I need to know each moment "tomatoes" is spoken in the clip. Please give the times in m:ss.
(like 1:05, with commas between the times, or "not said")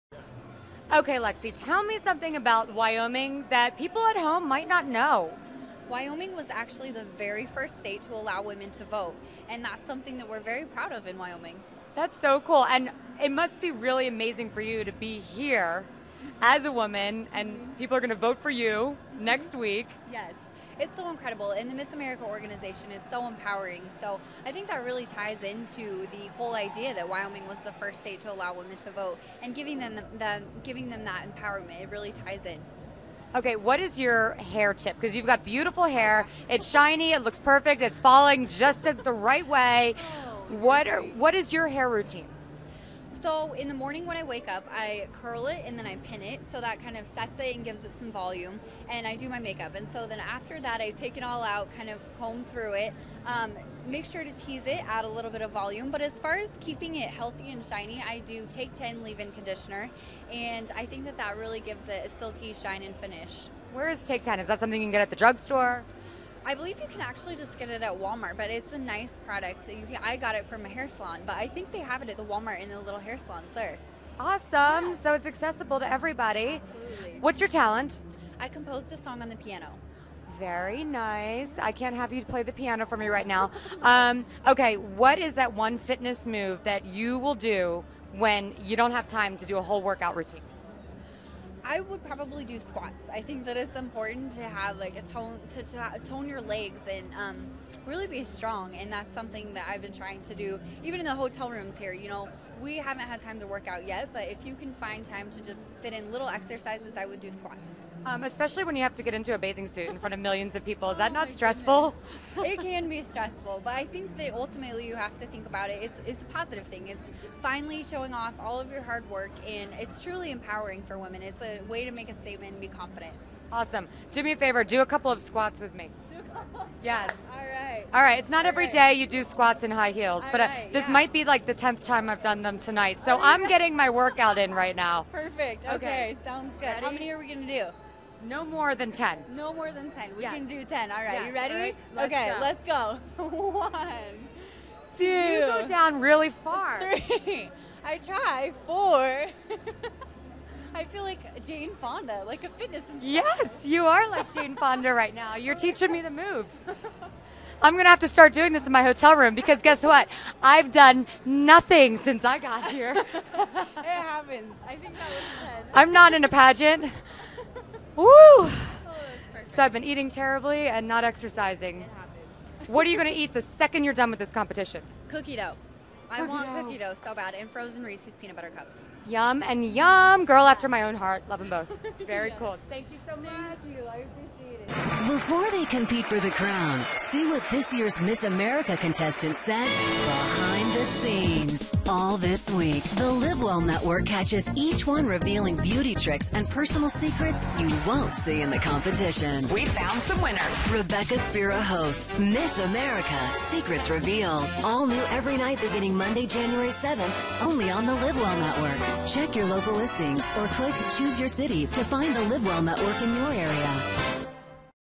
not said.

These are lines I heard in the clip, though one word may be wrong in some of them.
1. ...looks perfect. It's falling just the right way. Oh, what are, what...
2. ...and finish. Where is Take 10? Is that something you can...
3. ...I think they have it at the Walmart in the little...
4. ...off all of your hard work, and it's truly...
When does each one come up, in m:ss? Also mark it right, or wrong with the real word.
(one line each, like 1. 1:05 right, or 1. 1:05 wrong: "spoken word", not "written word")
1. 0:37 right
2. 1:02 right
3. 1:11 right
4. 1:58 right.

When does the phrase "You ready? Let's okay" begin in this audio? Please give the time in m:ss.
2:21.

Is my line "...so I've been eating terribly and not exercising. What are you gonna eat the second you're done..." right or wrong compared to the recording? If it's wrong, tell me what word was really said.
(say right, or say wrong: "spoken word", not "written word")
right.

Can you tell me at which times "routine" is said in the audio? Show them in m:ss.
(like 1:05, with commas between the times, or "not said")
0:41, 1:30.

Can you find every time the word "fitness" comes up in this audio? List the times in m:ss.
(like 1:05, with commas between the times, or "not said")
1:25, 2:32.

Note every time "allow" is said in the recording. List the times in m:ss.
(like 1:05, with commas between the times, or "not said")
0:08, 0:28.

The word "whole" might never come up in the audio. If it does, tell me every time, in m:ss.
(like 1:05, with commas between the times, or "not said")
0:26, 1:29.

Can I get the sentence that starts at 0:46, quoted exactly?
So that kind of sets it and gives it some volume.